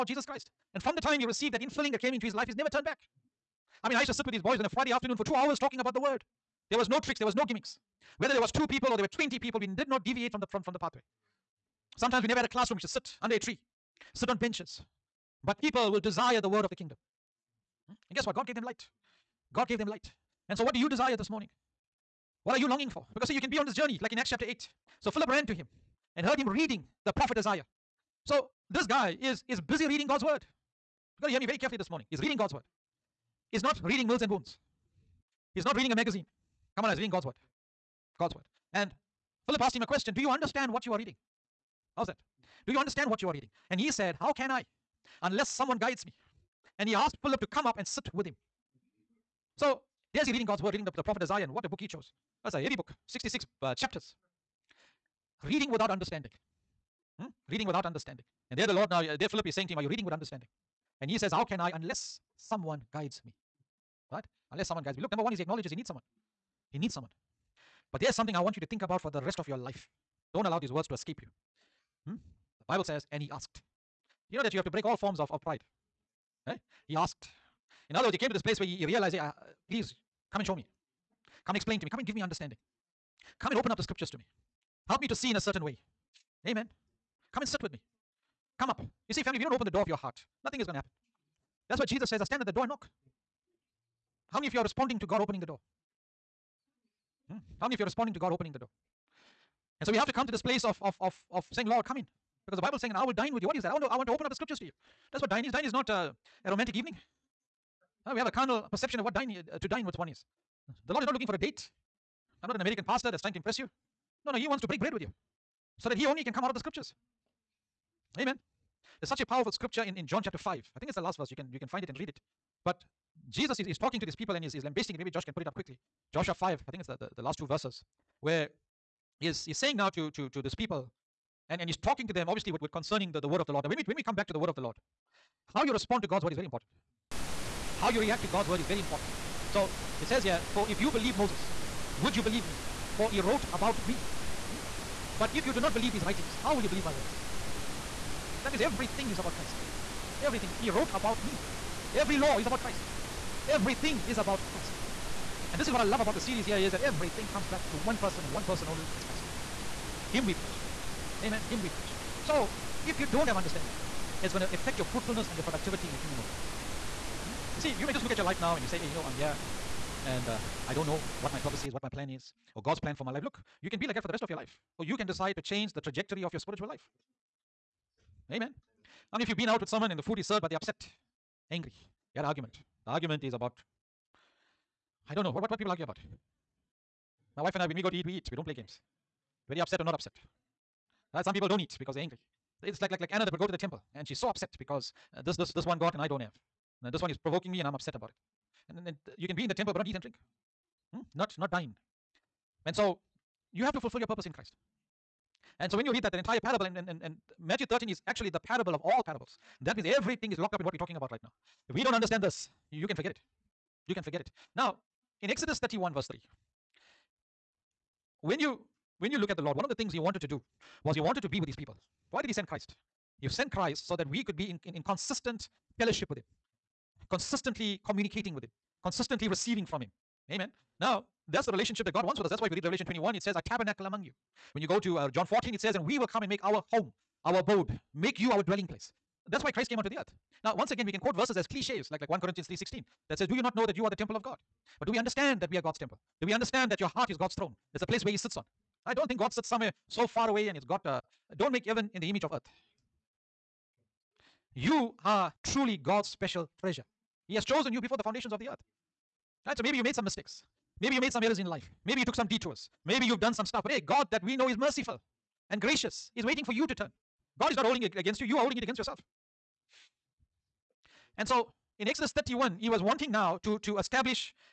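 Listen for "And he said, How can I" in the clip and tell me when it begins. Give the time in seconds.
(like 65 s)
43 s.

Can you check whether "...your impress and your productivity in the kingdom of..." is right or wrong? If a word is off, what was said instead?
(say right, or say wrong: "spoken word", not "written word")
wrong: "fruitfulness", not "impress".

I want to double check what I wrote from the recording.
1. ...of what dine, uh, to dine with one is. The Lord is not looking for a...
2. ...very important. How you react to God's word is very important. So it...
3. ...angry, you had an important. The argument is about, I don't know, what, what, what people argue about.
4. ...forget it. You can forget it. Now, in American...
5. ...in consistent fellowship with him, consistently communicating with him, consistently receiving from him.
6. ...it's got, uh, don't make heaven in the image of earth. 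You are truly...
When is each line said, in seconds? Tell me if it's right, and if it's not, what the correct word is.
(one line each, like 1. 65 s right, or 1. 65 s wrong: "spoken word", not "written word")
1. 108 s right
2. 136 s right
3. 181 s wrong: "argument", not "important"
4. 212 s wrong: "Exodus", not "American"
5. 224 s right
6. 250 s right.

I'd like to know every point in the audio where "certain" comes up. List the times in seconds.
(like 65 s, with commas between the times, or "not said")
85 s.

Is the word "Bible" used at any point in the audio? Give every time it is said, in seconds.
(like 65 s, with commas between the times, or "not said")
72 s, 102 s.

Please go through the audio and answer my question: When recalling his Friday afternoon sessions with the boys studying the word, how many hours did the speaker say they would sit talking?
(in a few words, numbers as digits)
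2 hours.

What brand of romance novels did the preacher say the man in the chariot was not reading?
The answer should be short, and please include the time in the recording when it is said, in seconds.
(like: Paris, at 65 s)
Mills and Boons, at 34 s.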